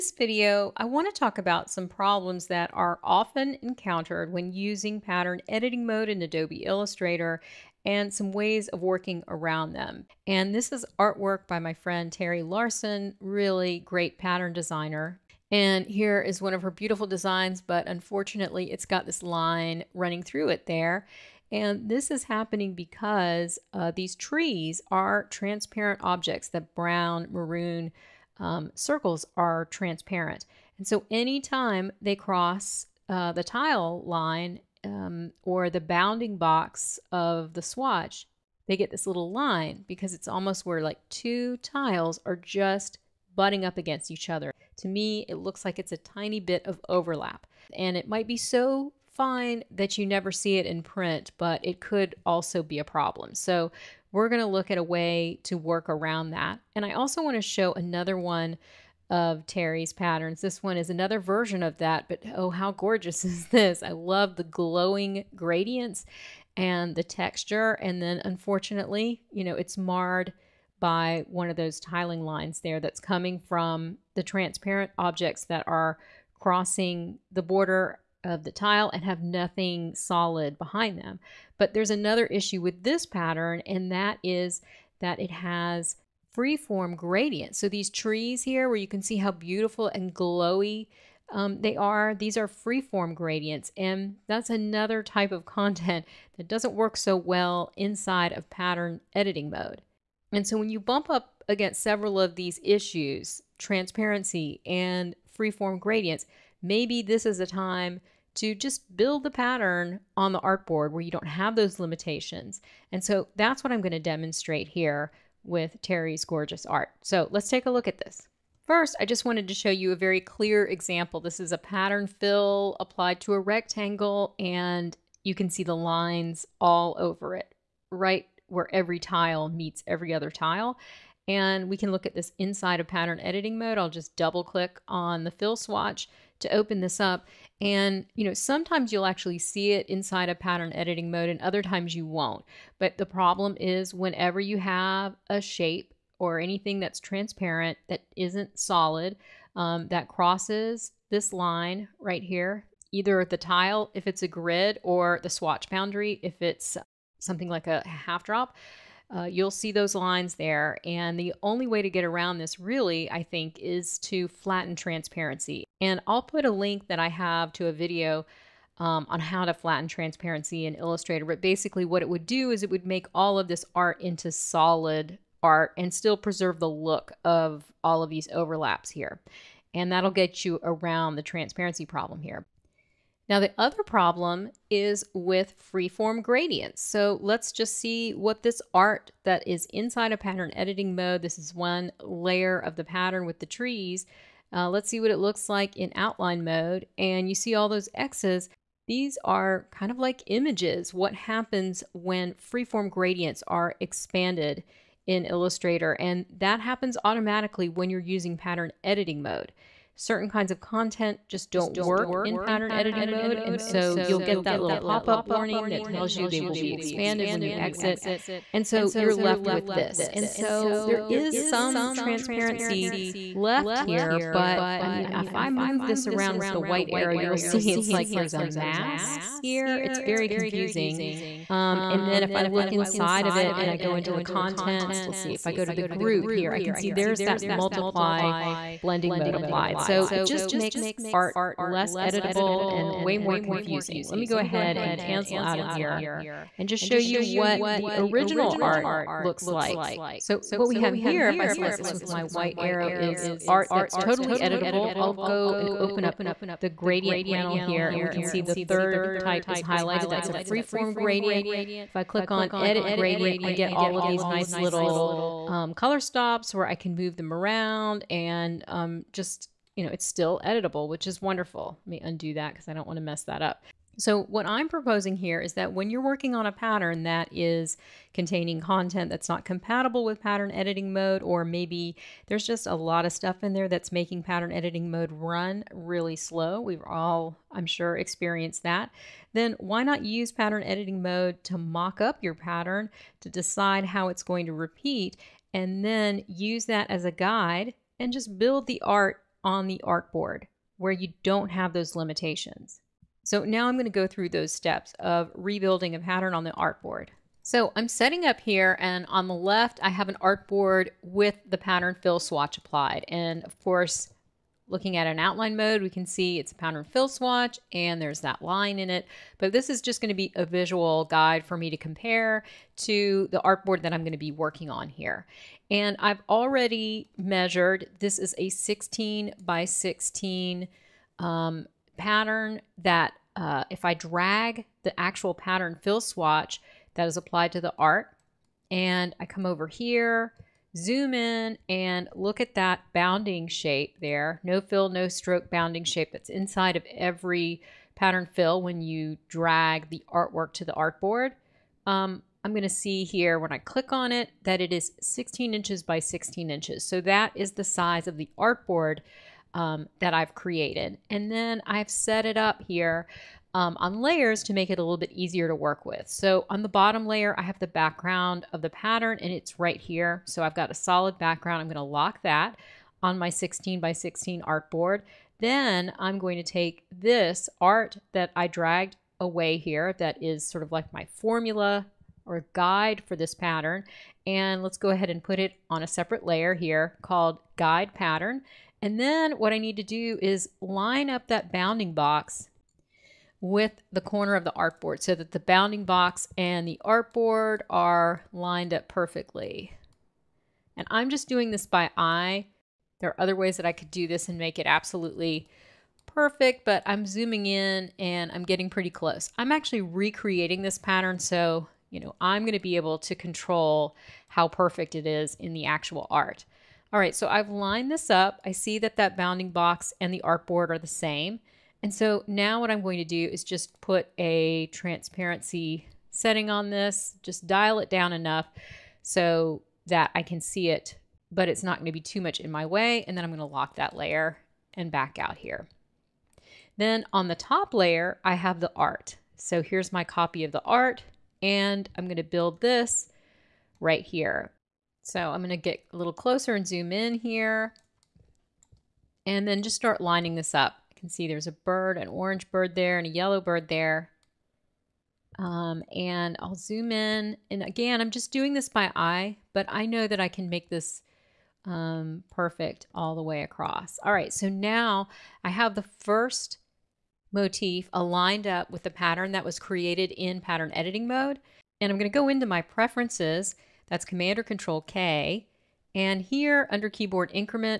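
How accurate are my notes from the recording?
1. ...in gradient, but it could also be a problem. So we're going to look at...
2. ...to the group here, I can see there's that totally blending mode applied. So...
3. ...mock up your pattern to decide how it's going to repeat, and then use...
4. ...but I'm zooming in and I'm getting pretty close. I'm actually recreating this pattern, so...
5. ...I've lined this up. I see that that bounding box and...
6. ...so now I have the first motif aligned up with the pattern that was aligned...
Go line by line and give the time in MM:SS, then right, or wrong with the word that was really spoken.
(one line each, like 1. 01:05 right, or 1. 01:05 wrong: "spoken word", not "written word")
1. 00:50 wrong: "print", not "gradient"
2. 03:55 wrong: "multiply", not "totally"
3. 04:51 right
4. 06:46 right
5. 06:57 right
6. 07:44 wrong: "created", not "aligned".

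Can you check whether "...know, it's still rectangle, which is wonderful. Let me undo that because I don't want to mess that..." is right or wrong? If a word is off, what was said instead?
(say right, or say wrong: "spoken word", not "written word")
wrong: "editable", not "rectangle".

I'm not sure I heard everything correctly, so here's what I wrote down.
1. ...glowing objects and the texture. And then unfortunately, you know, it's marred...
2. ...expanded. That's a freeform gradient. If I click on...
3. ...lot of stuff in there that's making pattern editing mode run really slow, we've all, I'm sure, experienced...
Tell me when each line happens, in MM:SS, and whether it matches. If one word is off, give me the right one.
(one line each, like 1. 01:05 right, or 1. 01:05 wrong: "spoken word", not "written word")
1. 01:04 wrong: "gradients", not "objects"
2. 04:19 wrong: "highlighted", not "expanded"
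3. 04:42 right.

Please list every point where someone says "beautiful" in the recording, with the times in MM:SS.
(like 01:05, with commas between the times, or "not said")
00:16, 01:29.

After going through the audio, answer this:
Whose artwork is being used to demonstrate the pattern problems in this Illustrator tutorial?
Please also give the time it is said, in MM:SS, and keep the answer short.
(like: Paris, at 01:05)
Teri Larson, at 00:12.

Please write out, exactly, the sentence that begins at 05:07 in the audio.
So I'm setting up here and on the left, I have an artboard with the pattern fill swatch applied.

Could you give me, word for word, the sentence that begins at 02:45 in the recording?
And I'll put a link that I have to a video um, on how to flatten transparency in Illustrator.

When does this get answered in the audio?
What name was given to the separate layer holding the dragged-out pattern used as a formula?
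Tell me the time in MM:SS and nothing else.
06:27.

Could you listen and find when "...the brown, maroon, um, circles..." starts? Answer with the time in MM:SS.
00:26.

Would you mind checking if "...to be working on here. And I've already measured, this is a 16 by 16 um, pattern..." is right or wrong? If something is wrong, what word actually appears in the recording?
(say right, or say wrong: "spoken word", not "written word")
right.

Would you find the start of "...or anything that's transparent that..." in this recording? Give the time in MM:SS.
02:26.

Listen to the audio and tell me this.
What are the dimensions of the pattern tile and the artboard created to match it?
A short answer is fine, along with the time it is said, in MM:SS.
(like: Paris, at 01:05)
16 by 16 inches, at 05:55.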